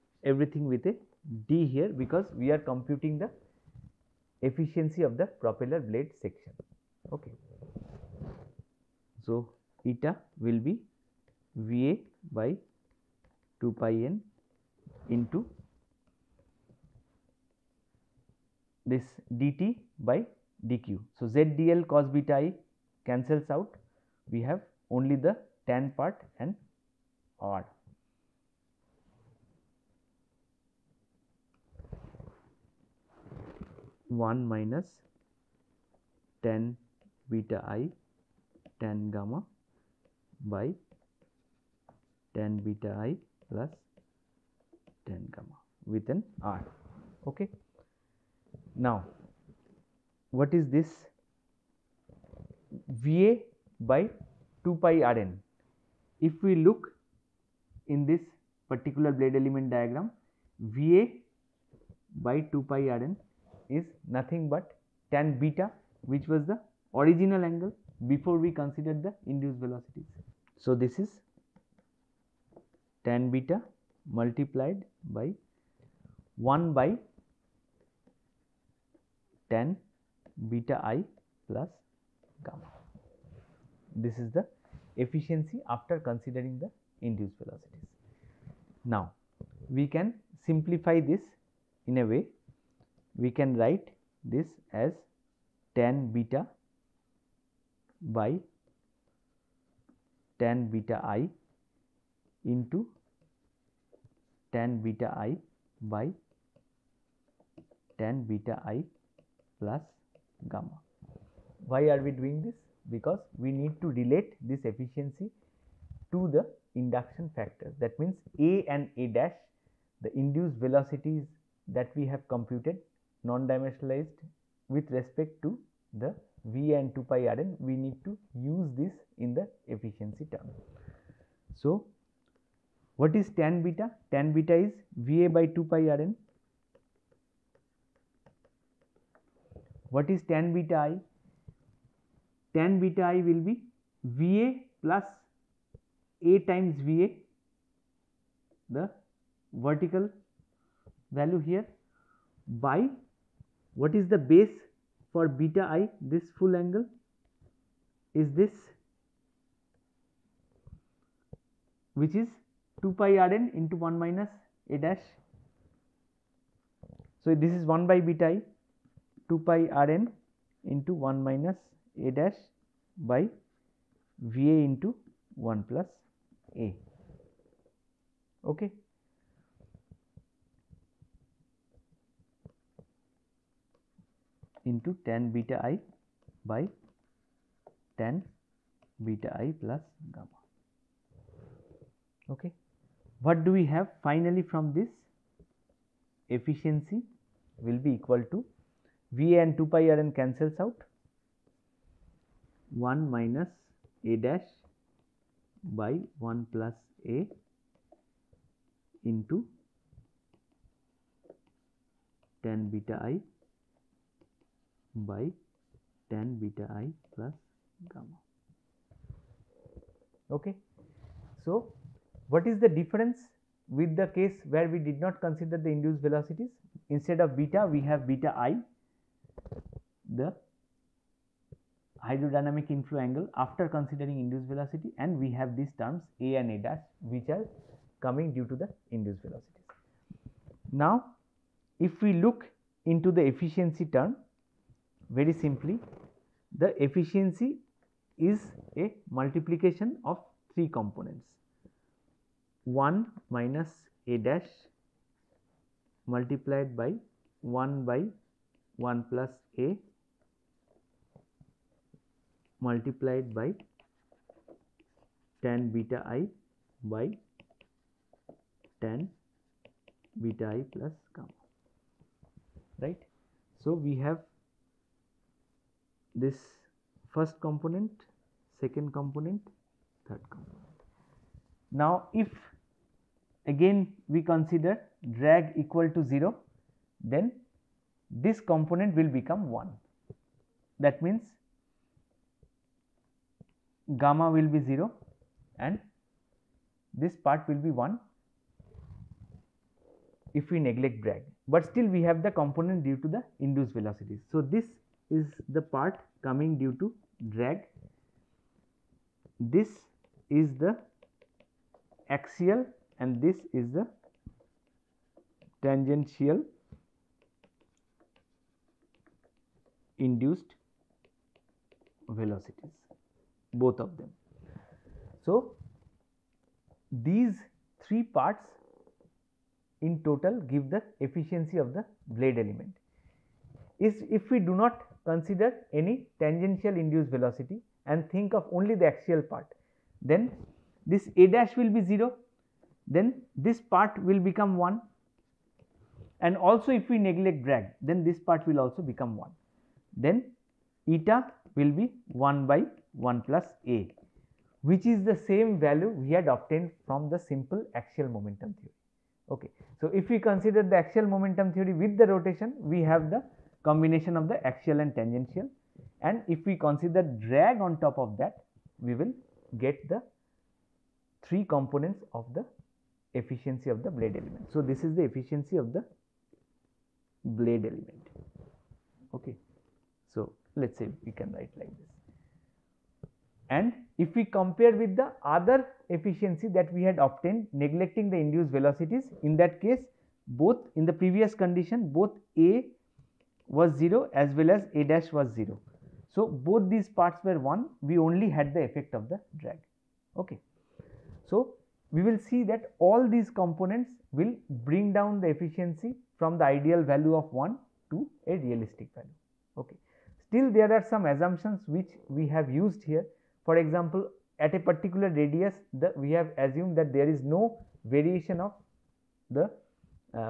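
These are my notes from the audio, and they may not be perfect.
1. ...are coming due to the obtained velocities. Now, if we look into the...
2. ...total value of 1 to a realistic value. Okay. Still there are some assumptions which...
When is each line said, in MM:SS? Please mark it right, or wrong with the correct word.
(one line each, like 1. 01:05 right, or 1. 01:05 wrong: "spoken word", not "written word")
1. 03:57 wrong: "induced", not "obtained"
2. 06:46 wrong: "ideal", not "total".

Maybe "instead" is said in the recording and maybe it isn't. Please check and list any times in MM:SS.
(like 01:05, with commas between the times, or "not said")
03:46.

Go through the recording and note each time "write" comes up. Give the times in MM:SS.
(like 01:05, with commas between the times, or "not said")
01:33, 06:21.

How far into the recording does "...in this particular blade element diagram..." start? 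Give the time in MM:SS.
00:57.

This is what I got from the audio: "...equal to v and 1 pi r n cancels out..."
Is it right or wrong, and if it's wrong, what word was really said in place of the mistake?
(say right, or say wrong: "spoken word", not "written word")
wrong: "2", not "1".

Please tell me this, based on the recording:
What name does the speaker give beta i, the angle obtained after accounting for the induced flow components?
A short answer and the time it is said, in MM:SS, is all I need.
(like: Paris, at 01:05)
Hydrodynamic inflow angle, at 03:52.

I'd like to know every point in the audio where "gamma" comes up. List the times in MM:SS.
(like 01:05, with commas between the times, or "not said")
00:39, 00:45, 01:22, 01:50, 03:10, 03:37, 04:31, 04:53.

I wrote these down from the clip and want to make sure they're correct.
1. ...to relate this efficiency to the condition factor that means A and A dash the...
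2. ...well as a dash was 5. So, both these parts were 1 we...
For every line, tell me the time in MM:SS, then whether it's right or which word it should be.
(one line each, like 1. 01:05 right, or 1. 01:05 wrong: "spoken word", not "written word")
1. 01:53 wrong: "induction", not "condition"
2. 06:34 wrong: "0", not "5".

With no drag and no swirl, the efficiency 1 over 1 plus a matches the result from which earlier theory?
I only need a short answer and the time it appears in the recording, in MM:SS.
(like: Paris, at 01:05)
Simple axial momentum theory, at 05:57.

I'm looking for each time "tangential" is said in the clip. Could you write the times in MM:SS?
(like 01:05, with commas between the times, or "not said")
05:15, 05:36, 06:04.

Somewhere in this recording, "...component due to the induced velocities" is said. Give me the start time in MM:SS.
05:02.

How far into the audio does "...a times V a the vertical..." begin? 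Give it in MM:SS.
02:26.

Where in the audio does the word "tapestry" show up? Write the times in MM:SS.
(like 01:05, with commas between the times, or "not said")
not said.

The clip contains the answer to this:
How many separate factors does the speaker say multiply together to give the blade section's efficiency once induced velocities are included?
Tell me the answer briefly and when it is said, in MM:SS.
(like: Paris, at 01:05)
3, at 04:10.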